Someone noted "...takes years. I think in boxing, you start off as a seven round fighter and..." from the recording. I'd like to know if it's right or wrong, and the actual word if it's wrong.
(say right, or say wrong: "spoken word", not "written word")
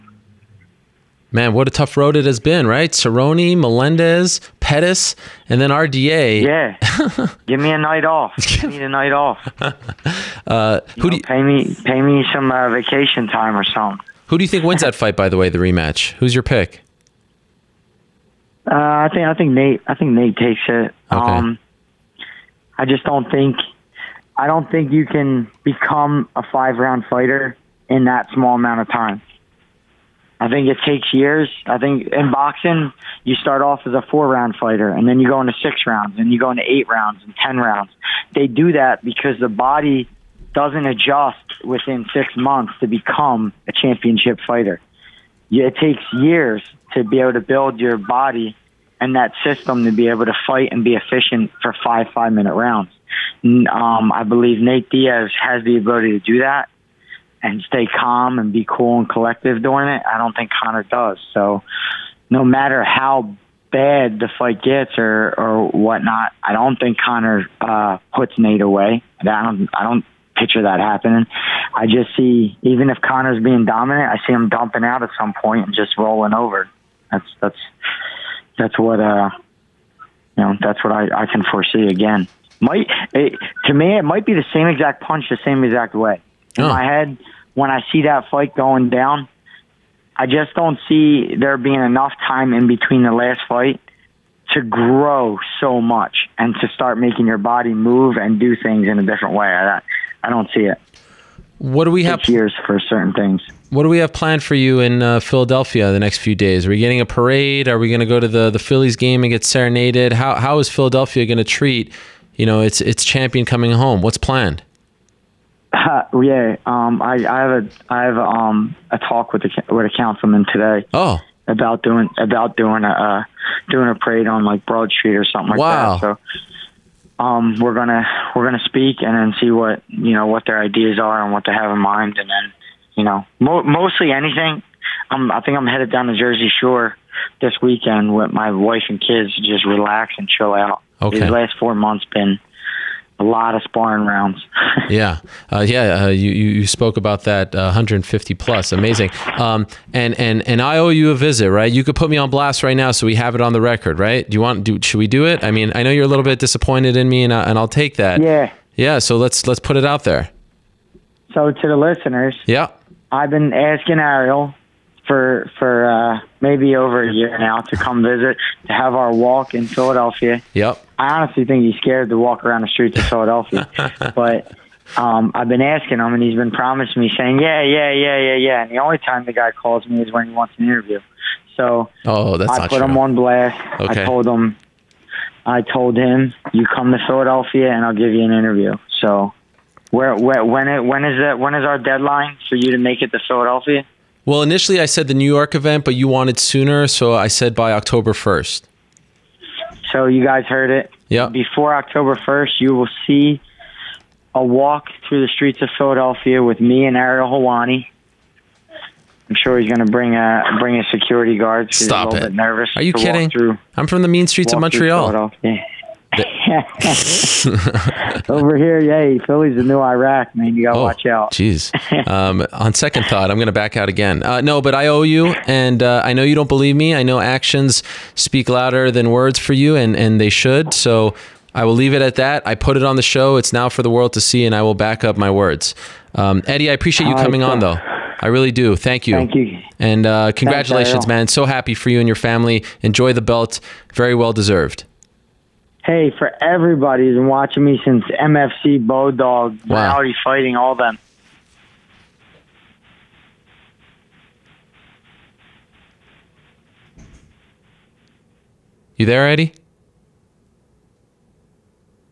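wrong: "four", not "seven".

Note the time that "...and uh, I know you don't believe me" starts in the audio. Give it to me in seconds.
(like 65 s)
225 s.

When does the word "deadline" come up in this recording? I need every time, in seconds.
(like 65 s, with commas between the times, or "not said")
191 s.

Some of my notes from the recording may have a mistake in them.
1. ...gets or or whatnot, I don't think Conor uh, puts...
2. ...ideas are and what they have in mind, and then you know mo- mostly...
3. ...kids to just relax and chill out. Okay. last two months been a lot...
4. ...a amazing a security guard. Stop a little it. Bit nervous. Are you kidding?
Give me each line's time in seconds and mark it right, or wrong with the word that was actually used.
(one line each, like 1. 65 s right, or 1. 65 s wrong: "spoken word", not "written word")
1. 64 s right
2. 130 s right
3. 139 s wrong: "four", not "two"
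4. 210 s wrong: "bring", not "amazing".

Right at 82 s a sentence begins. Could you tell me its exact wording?
Might it, to me, it might be the same exact punch, the same exact way.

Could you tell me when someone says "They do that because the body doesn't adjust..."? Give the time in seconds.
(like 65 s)
38 s.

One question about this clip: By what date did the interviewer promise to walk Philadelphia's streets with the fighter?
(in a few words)
October 1.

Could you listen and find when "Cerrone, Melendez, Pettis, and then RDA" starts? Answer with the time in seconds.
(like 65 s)
2 s.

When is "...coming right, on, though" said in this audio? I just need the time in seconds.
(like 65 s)
237 s.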